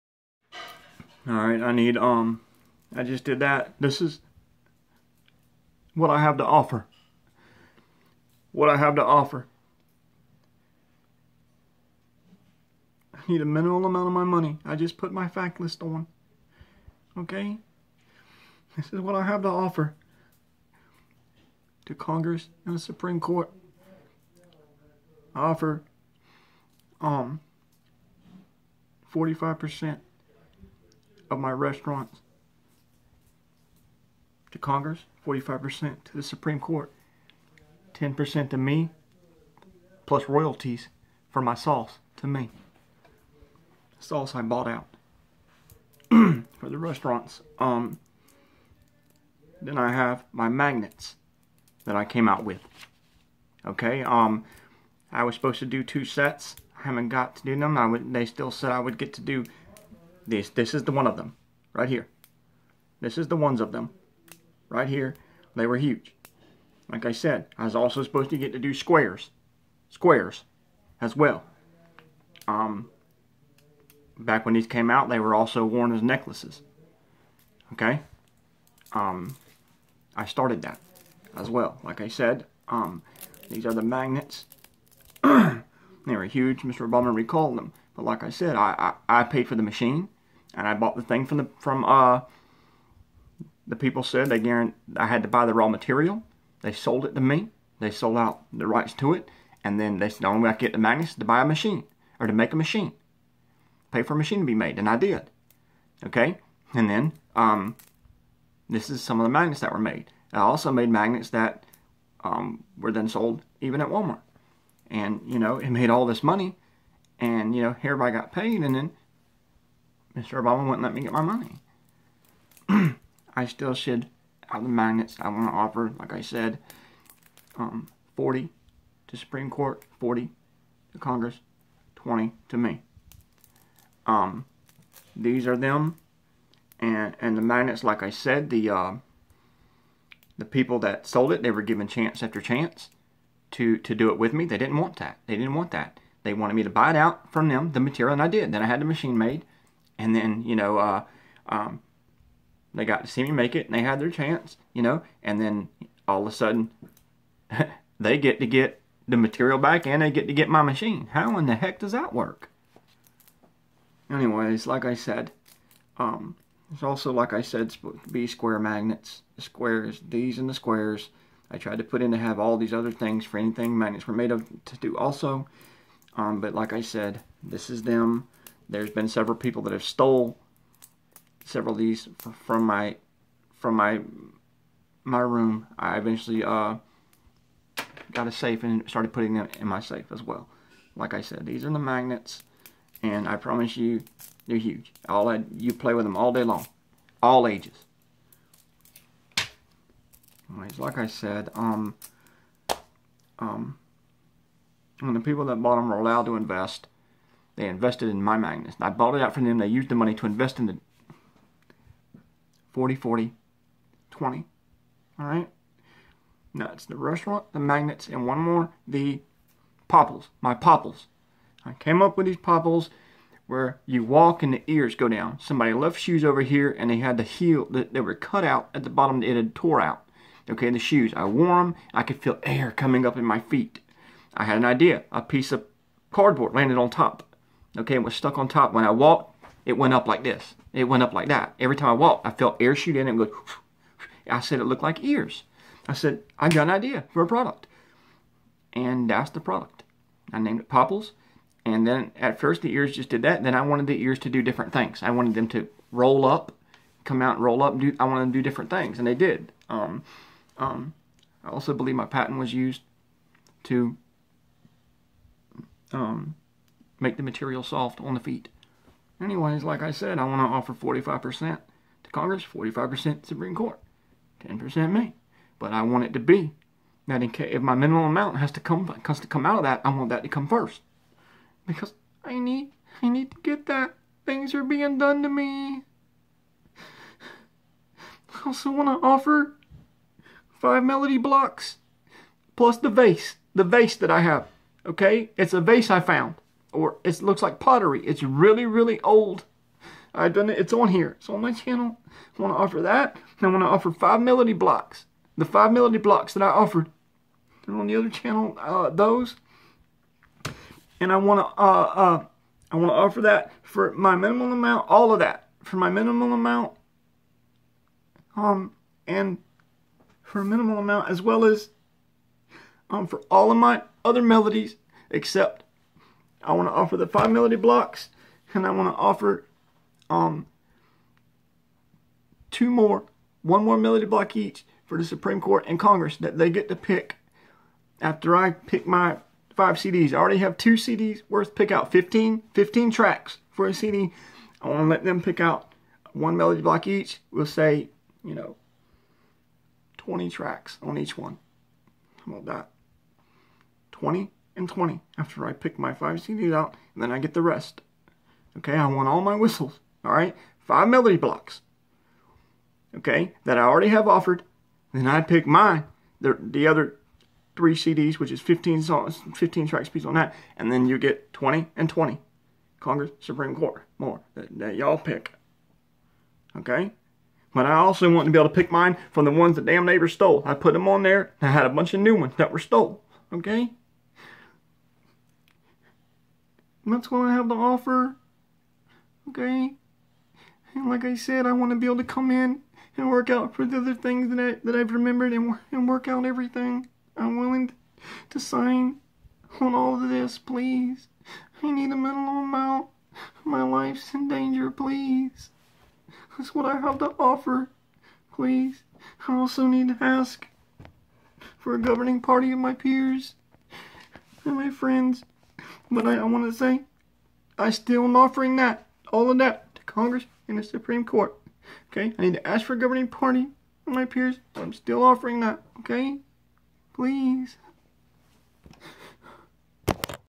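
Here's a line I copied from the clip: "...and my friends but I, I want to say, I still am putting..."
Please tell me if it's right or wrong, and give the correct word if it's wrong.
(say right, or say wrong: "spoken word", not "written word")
wrong: "offering", not "putting".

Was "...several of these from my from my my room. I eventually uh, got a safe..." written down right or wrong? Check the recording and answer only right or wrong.
right.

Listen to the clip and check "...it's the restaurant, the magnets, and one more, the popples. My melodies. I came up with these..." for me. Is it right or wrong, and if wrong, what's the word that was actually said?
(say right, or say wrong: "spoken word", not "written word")
wrong: "popples", not "melodies".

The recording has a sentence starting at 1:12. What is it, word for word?
Um, back when these came out, they were also worn as necklaces.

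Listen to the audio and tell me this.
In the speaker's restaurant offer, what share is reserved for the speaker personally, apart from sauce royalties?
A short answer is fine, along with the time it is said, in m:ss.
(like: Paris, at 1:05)
10%, at 0:37.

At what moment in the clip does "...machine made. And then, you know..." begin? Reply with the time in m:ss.
2:28.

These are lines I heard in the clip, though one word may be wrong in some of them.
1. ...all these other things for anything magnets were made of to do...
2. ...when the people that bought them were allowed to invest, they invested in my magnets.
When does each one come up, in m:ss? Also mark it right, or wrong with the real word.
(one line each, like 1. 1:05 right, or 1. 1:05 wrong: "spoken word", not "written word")
1. 2:52 right
2. 3:25 right.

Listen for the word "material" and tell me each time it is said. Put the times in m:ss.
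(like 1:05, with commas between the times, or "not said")
1:35, 2:27, 2:39, 4:27.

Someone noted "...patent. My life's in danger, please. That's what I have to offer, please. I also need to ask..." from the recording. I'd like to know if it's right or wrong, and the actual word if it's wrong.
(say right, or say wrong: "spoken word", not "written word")
wrong: "amount", not "patent".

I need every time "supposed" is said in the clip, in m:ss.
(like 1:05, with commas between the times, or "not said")
0:55, 1:08.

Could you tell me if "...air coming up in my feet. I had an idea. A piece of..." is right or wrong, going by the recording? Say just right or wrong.
right.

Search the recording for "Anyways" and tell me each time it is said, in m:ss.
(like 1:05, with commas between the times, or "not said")
2:44, 3:20, 4:29.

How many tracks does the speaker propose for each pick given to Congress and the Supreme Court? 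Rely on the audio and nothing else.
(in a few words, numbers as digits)
20.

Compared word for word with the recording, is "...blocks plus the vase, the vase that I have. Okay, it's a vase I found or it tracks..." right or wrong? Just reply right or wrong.
wrong.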